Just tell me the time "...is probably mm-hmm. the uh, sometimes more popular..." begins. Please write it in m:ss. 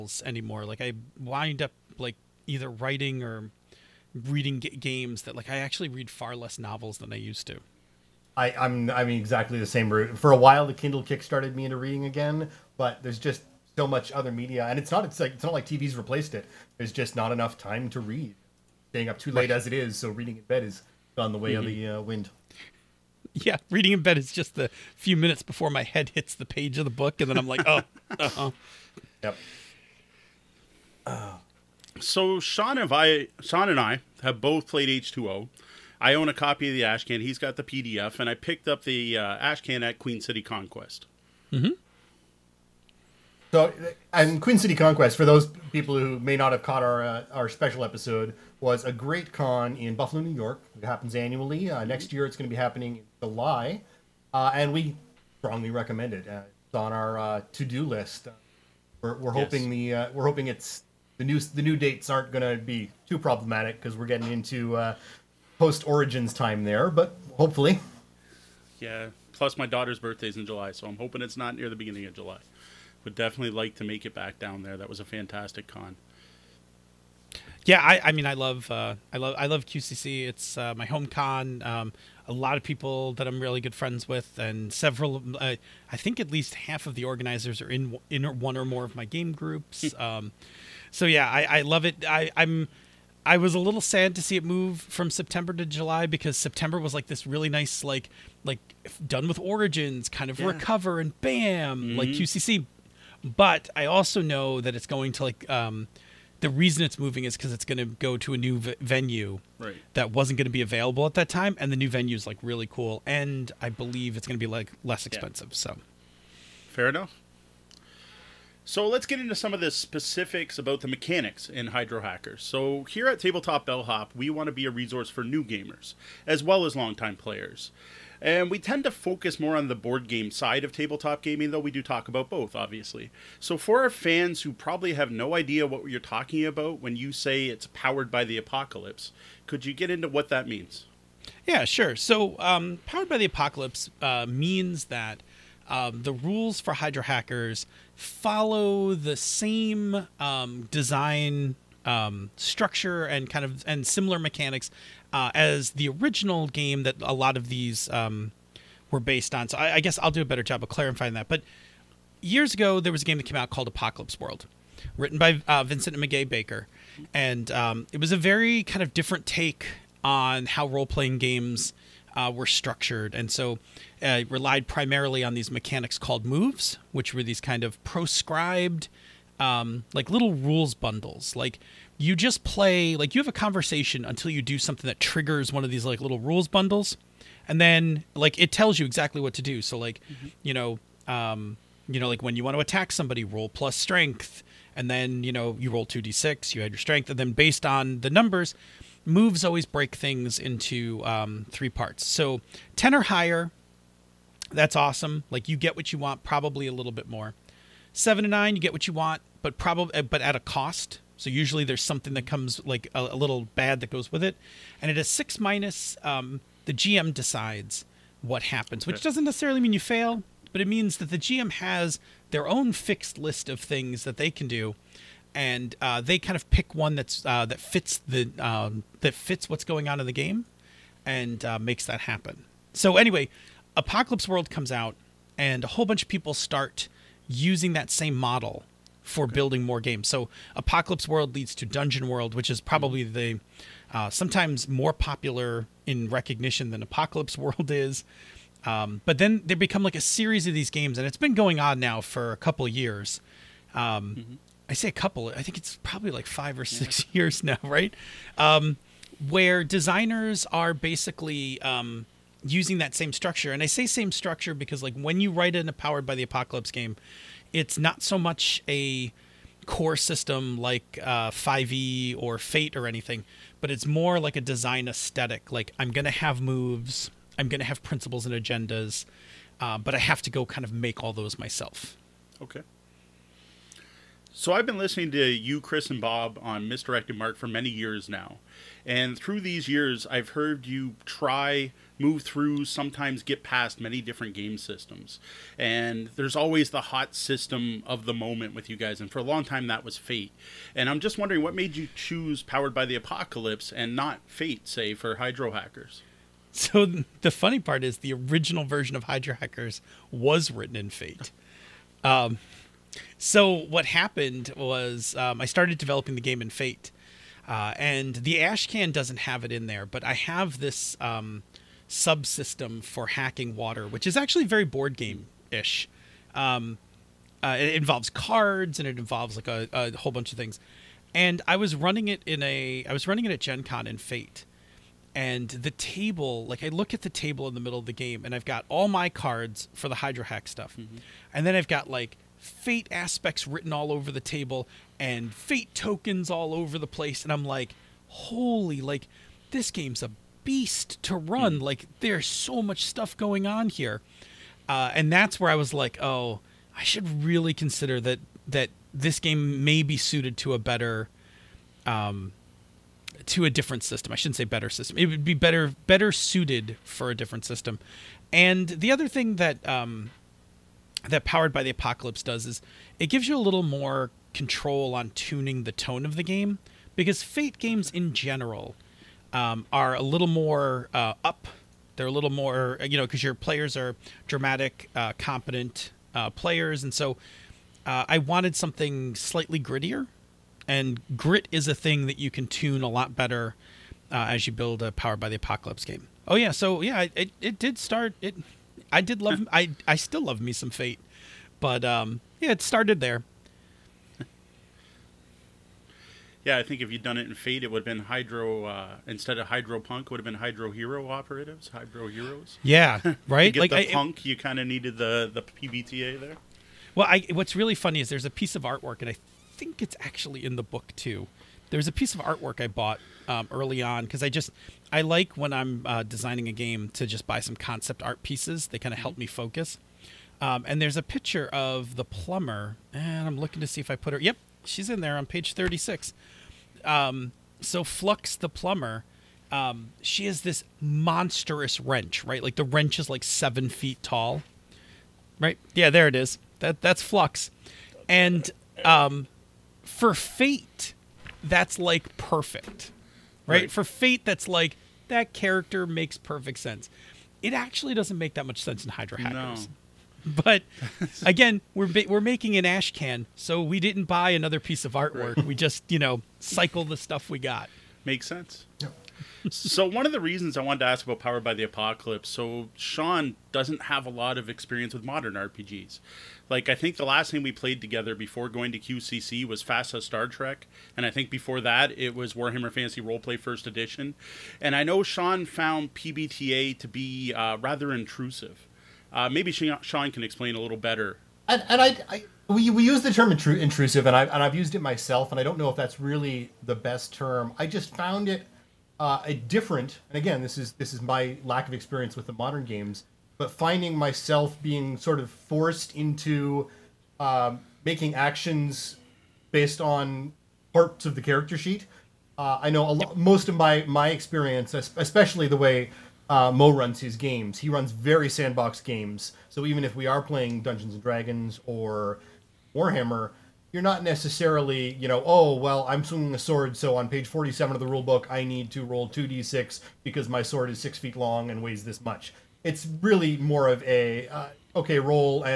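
4:02.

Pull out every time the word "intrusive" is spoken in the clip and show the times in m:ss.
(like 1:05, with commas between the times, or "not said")
8:07, 8:13.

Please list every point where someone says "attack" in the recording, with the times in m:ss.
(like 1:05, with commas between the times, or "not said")
3:12.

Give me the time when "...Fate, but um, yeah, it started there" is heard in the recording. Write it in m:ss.
6:40.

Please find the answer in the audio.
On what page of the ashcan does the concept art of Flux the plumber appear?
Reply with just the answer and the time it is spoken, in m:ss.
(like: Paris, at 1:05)
36, at 7:15.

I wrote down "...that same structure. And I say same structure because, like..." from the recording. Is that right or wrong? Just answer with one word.
right.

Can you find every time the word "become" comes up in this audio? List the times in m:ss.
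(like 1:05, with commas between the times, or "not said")
4:09.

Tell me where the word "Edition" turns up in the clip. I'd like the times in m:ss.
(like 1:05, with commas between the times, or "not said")
8:03.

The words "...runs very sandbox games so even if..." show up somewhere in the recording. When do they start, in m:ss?
8:37.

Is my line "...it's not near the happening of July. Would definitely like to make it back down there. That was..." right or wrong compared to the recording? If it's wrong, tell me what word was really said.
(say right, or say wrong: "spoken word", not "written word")
wrong: "beginning", not "happening".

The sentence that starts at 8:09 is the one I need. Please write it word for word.
Uh, maybe Sean can explain a little better.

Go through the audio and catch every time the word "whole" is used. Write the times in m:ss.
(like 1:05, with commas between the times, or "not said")
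3:55, 5:29.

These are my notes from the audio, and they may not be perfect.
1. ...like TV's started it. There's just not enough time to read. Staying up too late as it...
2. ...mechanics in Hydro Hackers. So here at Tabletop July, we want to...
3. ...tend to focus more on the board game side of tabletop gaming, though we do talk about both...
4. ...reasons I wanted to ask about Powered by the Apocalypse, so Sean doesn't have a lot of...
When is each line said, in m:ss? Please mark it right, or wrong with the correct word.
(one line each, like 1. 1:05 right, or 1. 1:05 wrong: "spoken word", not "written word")
1. 0:15 wrong: "replaced", not "started"
2. 2:00 wrong: "Bellhop", not "July"
3. 2:08 right
4. 7:50 right.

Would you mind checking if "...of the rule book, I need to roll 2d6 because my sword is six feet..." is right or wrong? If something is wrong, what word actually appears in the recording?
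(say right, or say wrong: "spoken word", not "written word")
right.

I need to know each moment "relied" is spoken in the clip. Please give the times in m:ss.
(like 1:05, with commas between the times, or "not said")
2:54.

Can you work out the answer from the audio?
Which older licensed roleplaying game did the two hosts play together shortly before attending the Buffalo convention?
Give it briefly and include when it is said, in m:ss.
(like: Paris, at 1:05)
FASA Star Trek, at 7:59.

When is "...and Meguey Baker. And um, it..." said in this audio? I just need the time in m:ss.
2:45.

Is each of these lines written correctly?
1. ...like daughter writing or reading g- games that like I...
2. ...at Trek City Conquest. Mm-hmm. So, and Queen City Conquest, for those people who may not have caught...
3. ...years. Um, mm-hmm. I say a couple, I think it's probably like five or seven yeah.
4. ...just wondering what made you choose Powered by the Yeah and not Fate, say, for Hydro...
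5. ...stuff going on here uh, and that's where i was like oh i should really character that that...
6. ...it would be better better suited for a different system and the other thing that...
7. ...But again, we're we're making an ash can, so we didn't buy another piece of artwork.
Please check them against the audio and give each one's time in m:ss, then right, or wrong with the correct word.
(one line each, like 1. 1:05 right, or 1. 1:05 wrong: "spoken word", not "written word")
1. 0:01 wrong: "either", not "daughter"
2. 0:39 wrong: "Queen", not "Trek"
3. 4:12 wrong: "six", not "seven"
4. 5:00 wrong: "Apocalypse", not "Yeah"
5. 5:52 wrong: "consider", not "character"
6. 6:04 right
7. 7:40 right.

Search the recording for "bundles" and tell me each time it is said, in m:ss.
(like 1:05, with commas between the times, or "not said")
3:00, 3:06.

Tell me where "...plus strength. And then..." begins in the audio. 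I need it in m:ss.
3:13.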